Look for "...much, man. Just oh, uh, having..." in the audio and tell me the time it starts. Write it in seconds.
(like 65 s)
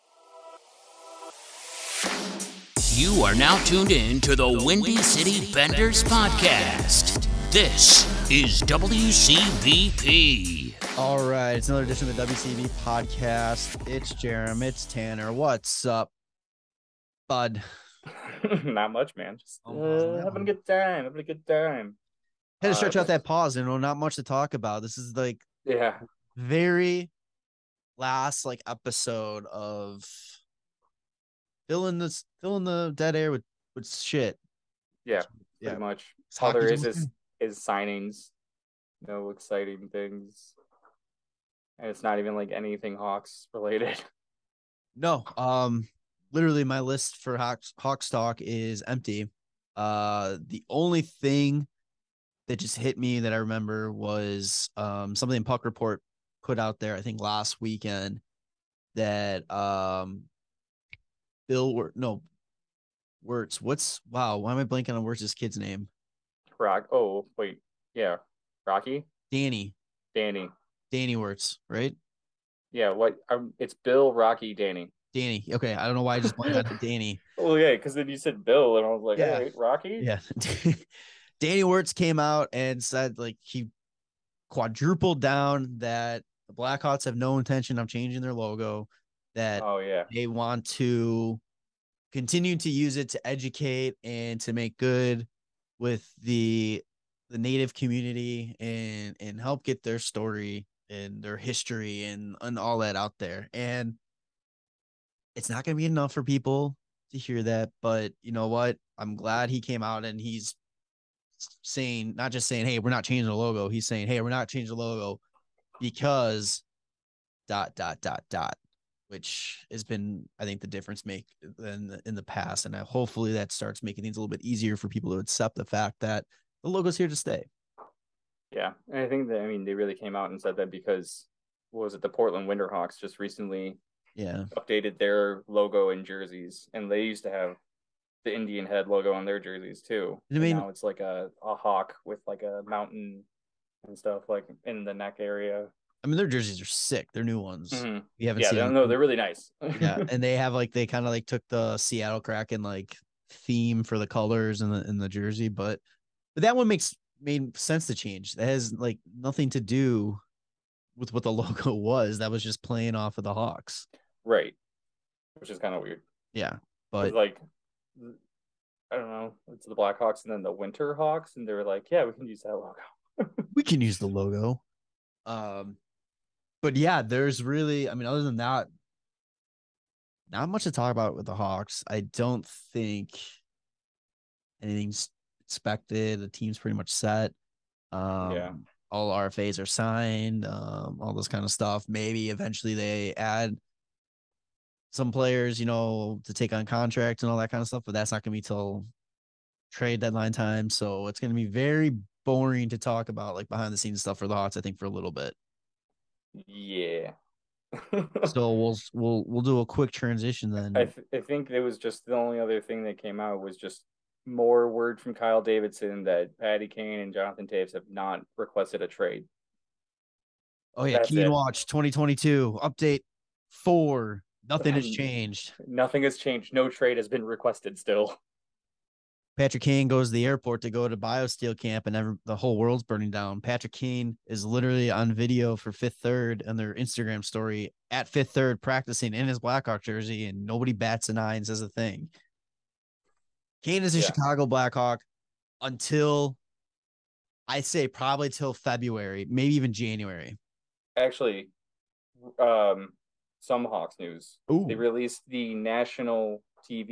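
18 s.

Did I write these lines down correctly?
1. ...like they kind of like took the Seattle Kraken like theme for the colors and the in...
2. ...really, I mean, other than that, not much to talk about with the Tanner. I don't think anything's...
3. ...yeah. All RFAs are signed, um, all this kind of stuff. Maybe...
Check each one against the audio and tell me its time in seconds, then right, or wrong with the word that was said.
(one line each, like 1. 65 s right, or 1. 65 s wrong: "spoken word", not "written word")
1. 150 s right
2. 177 s wrong: "Hawks", not "Tanner"
3. 188 s right.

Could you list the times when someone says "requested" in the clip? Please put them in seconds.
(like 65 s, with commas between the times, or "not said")
218 s, 227 s.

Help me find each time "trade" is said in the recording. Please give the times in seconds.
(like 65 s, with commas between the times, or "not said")
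199 s, 218 s, 226 s.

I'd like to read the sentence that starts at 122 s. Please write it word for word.
And hopefully that starts making things a little bit easier for people to accept the fact that the logo's here to stay.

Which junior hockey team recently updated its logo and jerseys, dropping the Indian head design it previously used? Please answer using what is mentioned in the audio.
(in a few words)
Portland Winterhawks.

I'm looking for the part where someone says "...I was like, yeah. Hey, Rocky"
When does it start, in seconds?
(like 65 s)
78 s.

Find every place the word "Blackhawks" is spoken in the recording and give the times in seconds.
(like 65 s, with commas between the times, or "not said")
86 s, 169 s, 239 s, 244 s.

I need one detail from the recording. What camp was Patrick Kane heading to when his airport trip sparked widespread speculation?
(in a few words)
BioSteel camp.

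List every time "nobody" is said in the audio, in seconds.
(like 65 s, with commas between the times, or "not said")
240 s.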